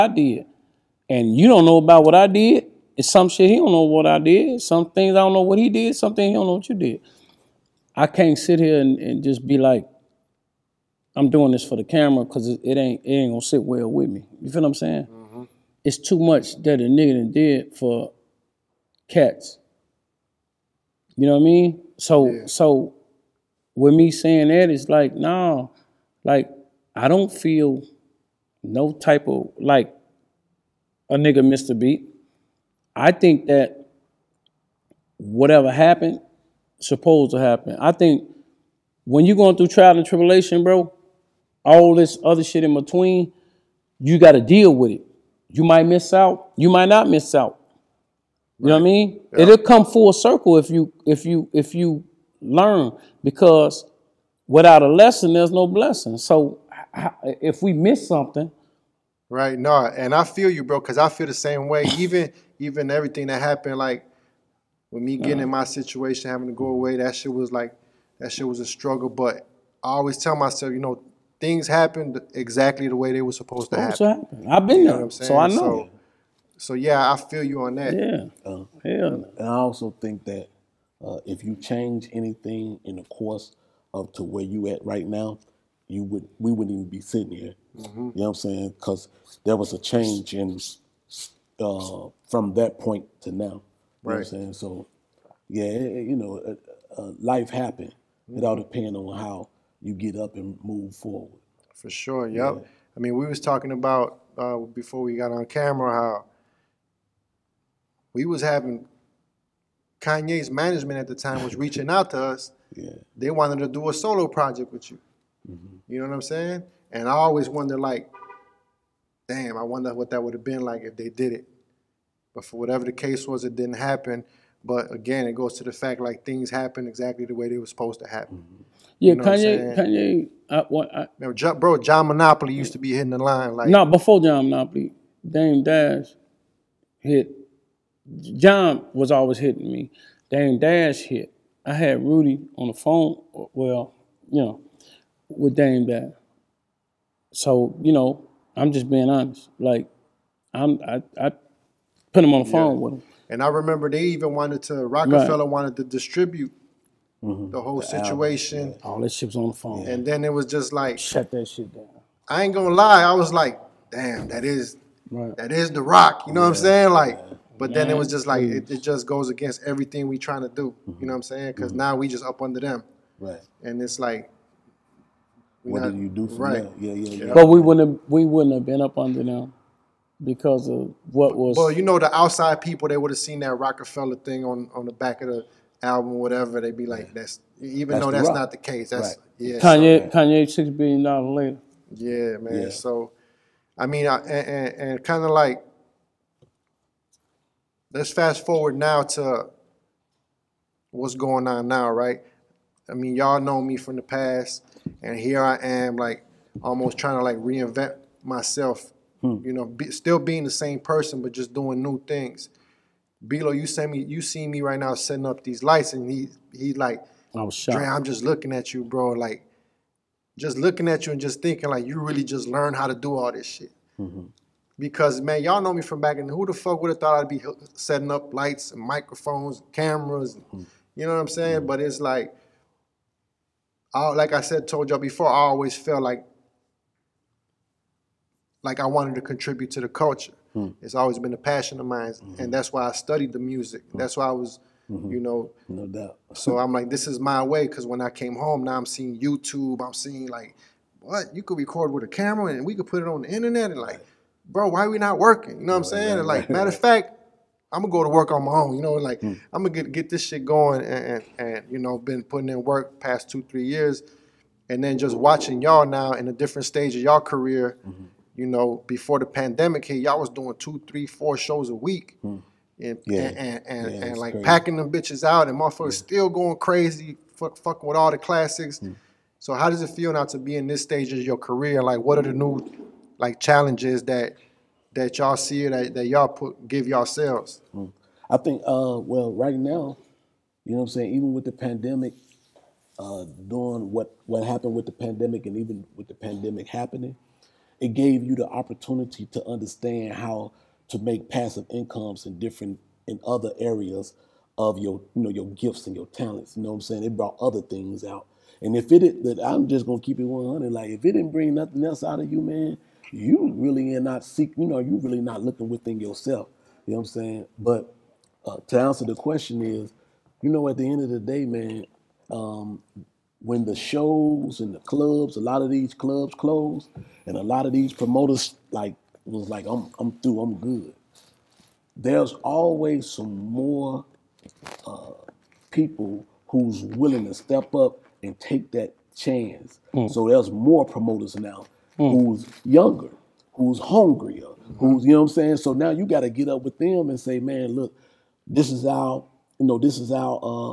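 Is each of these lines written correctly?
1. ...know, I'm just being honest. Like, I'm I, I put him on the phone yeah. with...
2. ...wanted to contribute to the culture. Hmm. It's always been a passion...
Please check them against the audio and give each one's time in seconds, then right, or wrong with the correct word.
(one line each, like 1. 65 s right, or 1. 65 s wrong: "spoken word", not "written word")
1. 147 s right
2. 238 s right.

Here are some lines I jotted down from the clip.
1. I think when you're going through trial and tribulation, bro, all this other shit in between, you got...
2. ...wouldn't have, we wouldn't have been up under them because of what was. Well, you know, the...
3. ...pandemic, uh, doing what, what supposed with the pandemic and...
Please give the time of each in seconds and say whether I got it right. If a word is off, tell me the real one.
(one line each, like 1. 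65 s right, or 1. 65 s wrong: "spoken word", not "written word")
1. 37 s right
2. 177 s right
3. 291 s wrong: "happened", not "supposed".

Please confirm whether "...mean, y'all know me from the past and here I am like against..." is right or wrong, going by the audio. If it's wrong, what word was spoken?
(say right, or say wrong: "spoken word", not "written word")
wrong: "almost", not "against".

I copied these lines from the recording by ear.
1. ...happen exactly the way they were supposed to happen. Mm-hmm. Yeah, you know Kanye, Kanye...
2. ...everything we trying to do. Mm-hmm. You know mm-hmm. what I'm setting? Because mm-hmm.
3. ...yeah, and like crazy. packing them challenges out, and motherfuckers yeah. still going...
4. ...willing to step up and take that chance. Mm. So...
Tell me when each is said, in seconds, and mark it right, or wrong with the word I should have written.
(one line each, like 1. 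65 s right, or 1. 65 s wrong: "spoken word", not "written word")
1. 126 s right
2. 169 s wrong: "saying", not "setting"
3. 273 s wrong: "bitches", not "challenges"
4. 336 s right.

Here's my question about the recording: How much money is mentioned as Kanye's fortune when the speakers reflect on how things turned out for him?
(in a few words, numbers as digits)
$6 billion.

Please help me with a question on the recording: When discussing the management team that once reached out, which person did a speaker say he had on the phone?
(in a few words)
Rudy.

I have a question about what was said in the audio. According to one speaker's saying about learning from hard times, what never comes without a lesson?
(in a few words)
No blessing.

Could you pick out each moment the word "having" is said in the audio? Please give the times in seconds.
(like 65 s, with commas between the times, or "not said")
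66 s, 108 s.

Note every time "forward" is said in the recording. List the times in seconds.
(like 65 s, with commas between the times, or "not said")
100 s, 198 s.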